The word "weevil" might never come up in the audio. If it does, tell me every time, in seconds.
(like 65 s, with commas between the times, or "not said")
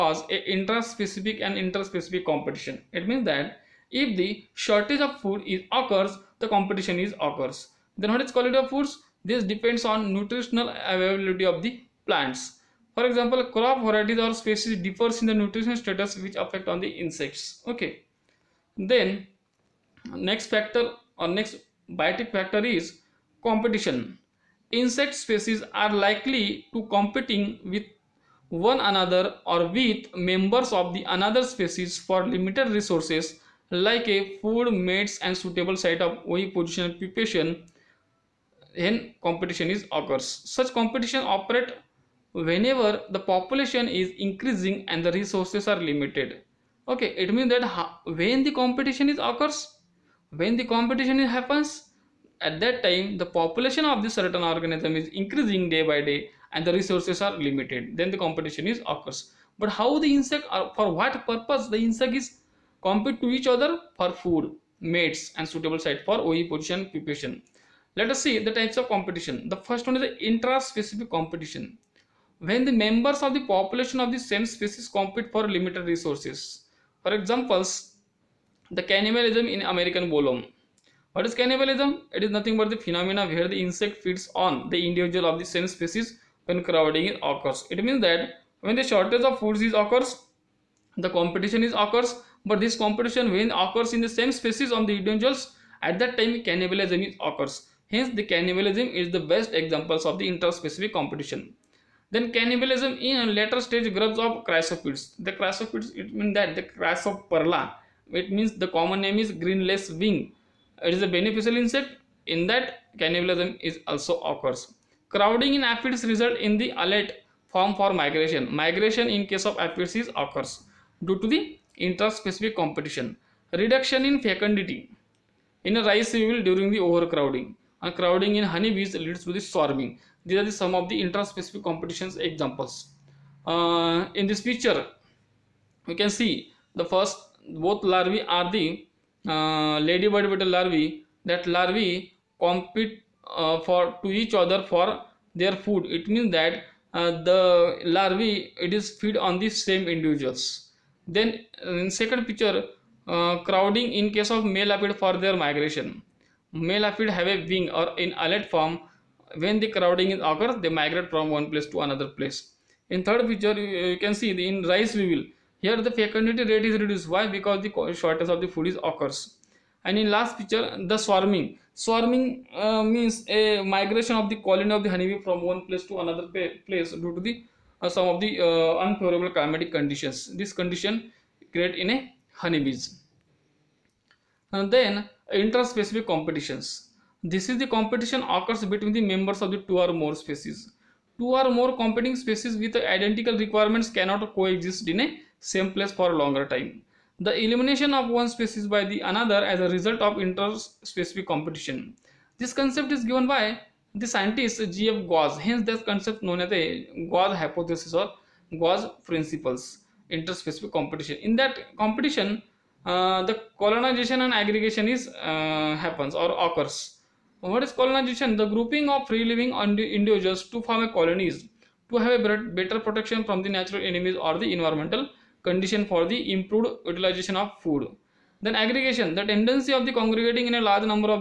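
126 s, 165 s.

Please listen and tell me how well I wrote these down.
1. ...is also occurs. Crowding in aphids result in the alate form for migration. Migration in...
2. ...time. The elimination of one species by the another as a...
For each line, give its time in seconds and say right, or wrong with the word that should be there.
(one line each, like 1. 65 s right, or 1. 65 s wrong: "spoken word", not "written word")
1. 113 s right
2. 196 s right.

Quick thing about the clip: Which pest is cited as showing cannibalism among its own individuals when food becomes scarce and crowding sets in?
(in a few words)
American bollworm.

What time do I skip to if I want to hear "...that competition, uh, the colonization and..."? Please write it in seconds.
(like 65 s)
211 s.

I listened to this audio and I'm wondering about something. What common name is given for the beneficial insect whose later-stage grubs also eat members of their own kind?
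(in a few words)
Green lacewing.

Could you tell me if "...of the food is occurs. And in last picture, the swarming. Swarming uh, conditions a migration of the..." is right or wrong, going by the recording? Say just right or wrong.
wrong.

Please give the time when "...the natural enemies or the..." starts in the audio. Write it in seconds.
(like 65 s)
223 s.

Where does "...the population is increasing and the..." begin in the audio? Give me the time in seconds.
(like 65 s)
43 s.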